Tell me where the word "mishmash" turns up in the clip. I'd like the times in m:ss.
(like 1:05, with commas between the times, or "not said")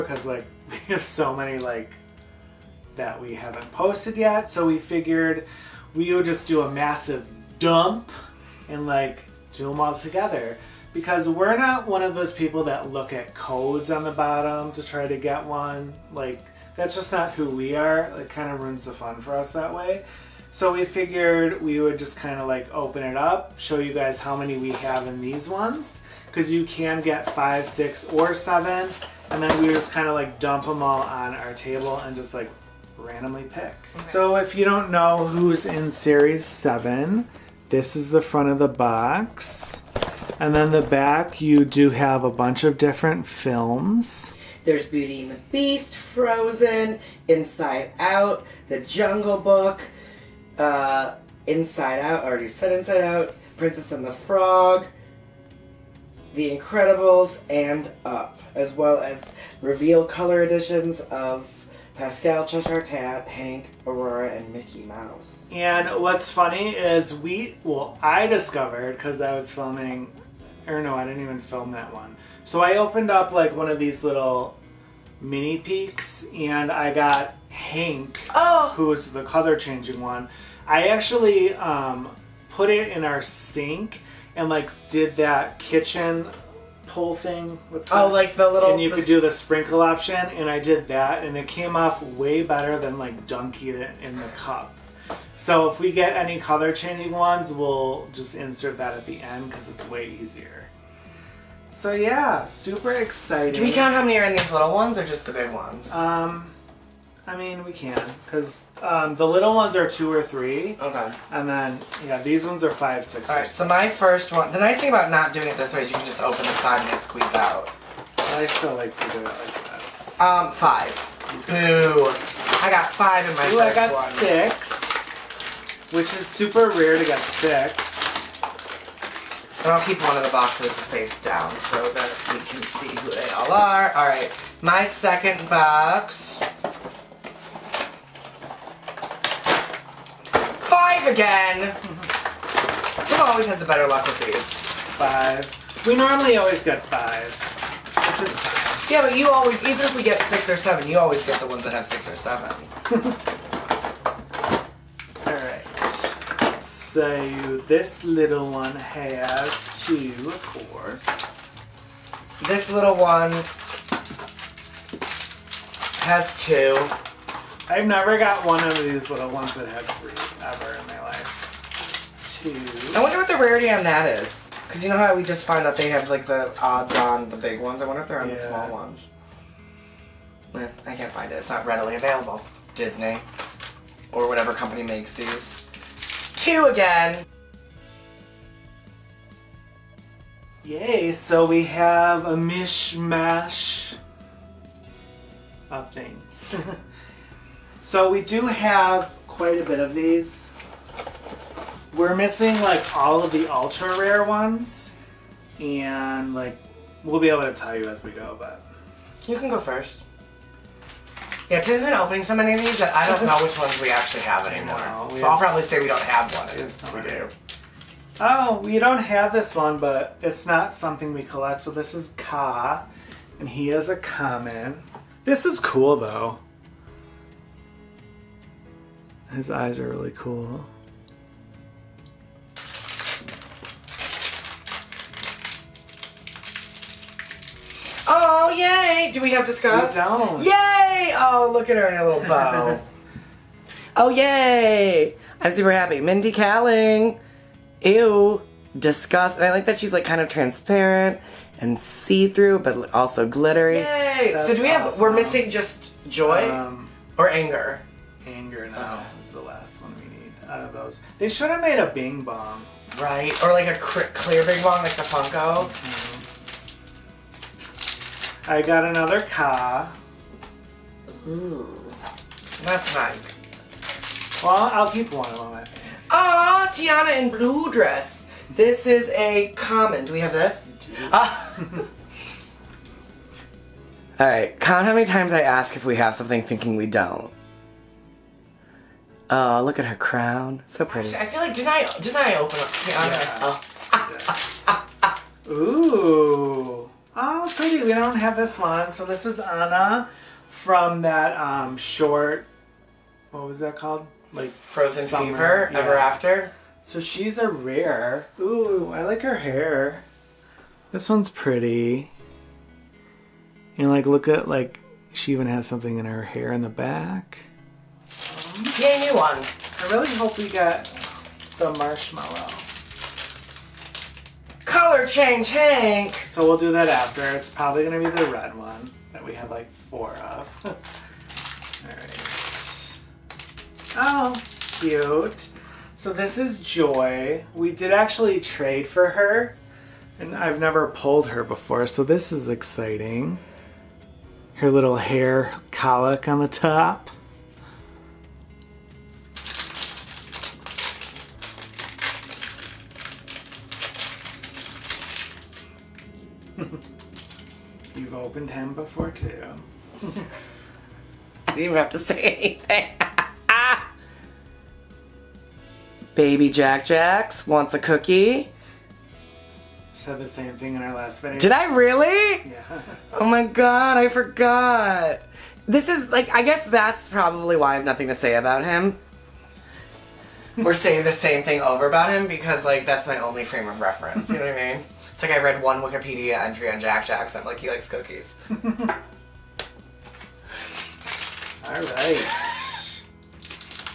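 3:12.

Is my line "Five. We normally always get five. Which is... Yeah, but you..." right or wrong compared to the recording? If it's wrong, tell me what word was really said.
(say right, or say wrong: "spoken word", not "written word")
right.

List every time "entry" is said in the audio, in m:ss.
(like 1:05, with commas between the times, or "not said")
6:26.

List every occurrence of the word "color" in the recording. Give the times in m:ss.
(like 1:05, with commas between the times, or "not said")
1:00, 1:19, 1:36, 5:24.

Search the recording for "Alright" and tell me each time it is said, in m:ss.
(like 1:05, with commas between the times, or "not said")
4:44, 5:31.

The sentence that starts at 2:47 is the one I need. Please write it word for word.
I've never got one of these little ones that have three ever in my life.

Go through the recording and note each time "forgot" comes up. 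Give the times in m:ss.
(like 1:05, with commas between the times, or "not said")
6:14.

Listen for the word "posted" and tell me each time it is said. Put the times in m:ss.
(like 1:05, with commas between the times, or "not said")
0:03.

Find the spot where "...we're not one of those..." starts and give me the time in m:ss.
0:11.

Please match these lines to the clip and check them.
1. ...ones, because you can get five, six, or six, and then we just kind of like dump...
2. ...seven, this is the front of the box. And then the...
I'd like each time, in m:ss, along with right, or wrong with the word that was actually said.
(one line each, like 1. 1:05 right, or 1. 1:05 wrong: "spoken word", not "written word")
1. 0:25 wrong: "seven", not "six"
2. 0:36 right.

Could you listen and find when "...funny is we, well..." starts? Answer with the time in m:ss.
1:06.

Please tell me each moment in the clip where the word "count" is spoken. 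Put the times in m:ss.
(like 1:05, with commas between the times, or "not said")
1:43, 4:44.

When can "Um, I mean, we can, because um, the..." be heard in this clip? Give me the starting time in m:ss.
1:45.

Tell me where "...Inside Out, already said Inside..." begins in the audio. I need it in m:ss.
0:51.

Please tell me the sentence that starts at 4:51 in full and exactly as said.
Actually, I feel like, didn't I, didn't I open up Tiana yeah.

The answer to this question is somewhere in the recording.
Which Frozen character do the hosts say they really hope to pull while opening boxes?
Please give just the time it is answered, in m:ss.
5:21.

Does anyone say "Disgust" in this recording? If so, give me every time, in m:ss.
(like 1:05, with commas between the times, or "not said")
3:59, 4:08.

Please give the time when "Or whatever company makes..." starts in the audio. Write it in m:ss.
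3:04.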